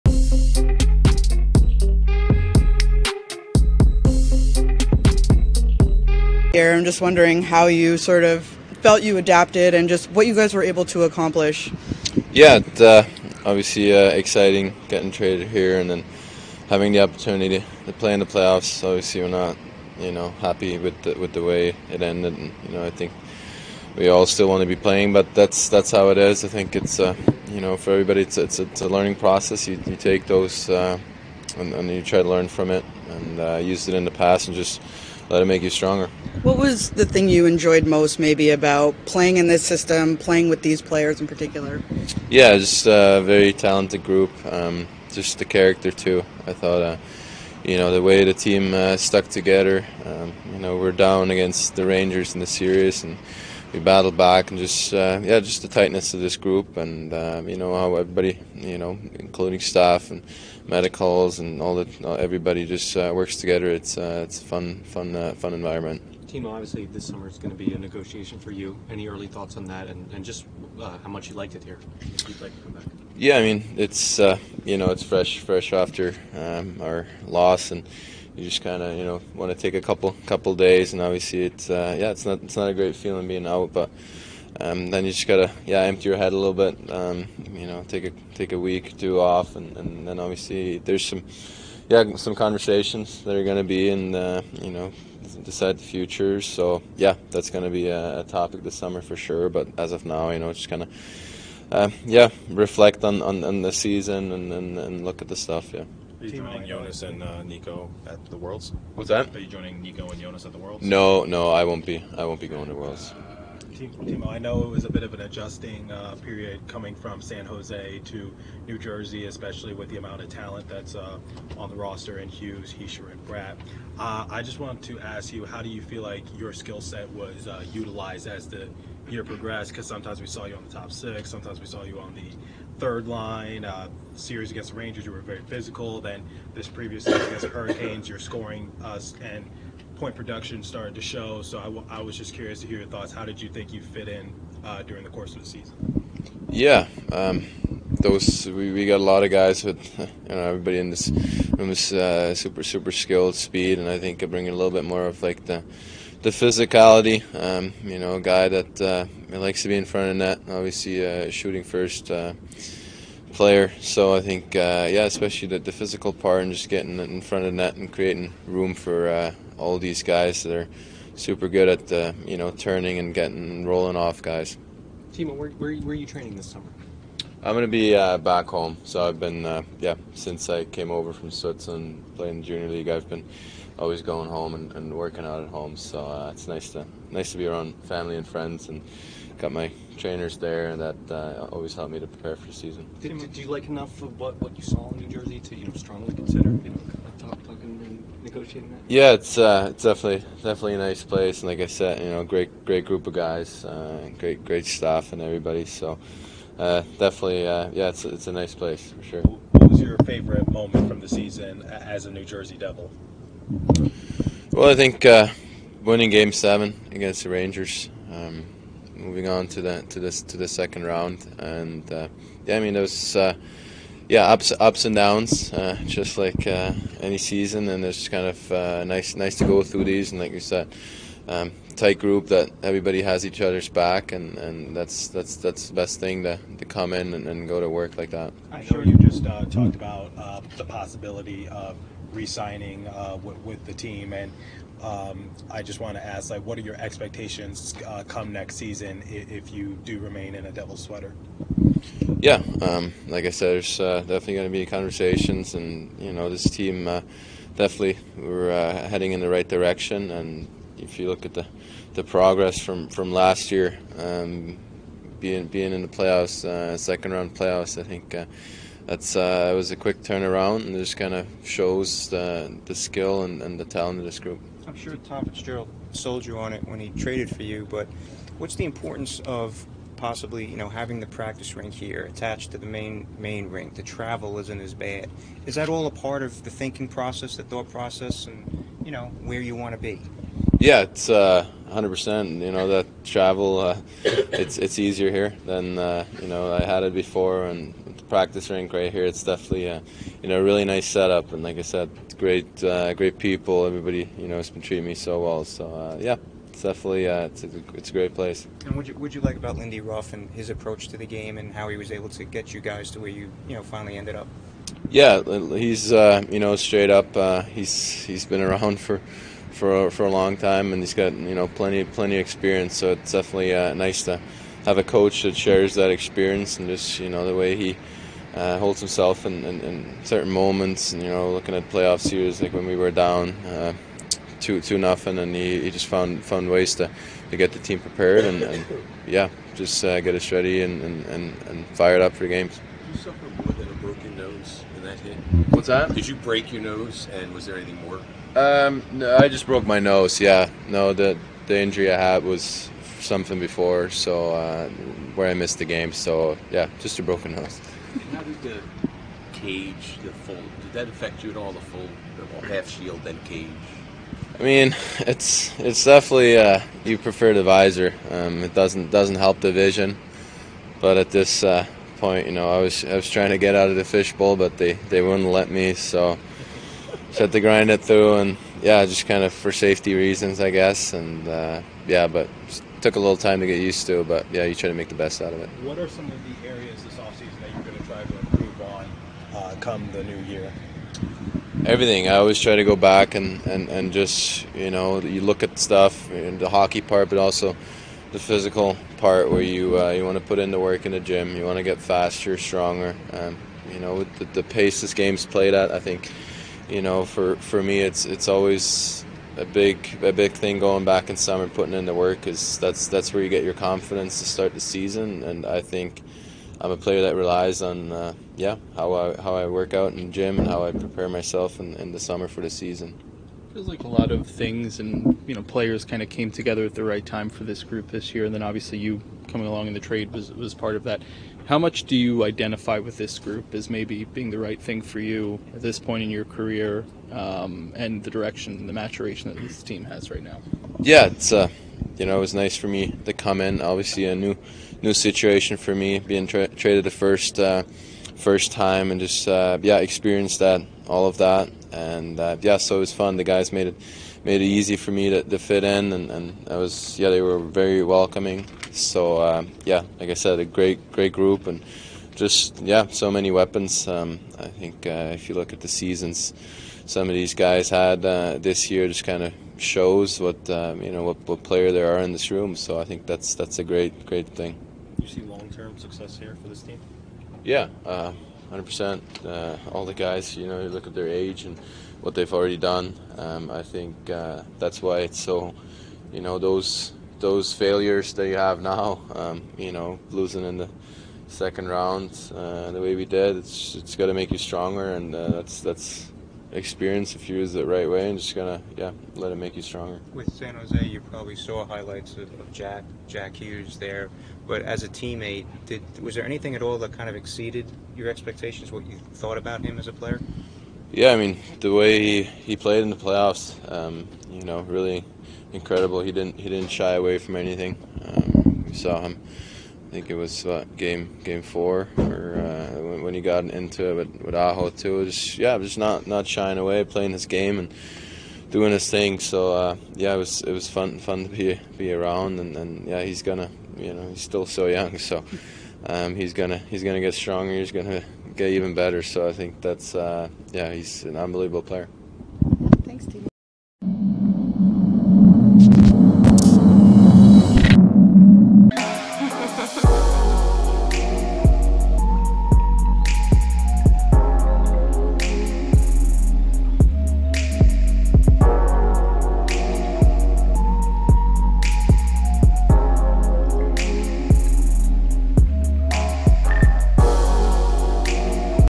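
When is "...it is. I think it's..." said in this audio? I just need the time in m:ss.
0:26.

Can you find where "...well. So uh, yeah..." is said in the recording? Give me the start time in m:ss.
5:05.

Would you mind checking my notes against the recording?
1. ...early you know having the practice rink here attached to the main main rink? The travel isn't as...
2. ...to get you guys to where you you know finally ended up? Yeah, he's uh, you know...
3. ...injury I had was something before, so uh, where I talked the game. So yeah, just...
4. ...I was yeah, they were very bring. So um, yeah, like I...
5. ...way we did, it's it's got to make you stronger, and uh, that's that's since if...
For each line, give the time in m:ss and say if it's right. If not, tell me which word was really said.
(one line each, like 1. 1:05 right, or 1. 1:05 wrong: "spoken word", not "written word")
1. 4:39 wrong: "possibly", not "early"
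2. 5:12 right
3. 5:51 wrong: "missed", not "talked"
4. 7:36 wrong: "welcoming", not "bring"
5. 8:12 wrong: "experience", not "since".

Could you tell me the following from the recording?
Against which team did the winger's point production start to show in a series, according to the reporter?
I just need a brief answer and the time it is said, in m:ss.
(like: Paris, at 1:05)
Hurricanes, at 2:17.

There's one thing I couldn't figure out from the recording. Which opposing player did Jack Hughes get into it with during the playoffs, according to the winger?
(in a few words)
Aho.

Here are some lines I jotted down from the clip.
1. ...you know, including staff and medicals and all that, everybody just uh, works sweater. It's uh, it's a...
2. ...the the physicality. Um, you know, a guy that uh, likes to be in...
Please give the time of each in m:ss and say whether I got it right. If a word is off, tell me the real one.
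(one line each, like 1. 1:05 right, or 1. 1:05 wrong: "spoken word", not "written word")
1. 0:58 wrong: "together", not "sweater"
2. 2:35 right.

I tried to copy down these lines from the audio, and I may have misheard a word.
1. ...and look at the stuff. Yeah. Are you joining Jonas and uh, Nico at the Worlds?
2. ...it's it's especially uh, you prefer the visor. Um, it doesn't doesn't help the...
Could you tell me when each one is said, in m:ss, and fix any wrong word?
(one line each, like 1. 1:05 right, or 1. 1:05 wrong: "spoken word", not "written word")
1. 1:44 right
2. 6:04 wrong: "definitely", not "especially".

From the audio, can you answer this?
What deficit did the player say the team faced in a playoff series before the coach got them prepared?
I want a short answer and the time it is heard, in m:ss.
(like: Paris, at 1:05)
2-0, at 5:34.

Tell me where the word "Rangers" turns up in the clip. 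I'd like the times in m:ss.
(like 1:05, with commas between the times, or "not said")
0:51, 2:14, 3:37.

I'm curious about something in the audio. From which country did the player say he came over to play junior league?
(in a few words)
Switzerland.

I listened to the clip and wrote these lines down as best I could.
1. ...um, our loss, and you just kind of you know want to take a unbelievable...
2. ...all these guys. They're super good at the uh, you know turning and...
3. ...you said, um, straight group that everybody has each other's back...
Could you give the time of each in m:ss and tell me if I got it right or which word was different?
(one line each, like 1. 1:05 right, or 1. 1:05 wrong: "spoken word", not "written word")
1. 1:16 wrong: "couple", not "unbelievable"
2. 2:49 right
3. 3:50 wrong: "tight", not "straight".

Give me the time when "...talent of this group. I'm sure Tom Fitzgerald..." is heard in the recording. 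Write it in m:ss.
4:33.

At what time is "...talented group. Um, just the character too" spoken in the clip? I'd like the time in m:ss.
0:43.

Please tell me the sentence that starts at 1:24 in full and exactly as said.
Um, then you just gotta, yeah, empty your head a little bit.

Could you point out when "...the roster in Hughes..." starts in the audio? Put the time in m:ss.
2:01.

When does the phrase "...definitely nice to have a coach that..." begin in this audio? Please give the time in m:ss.
5:23.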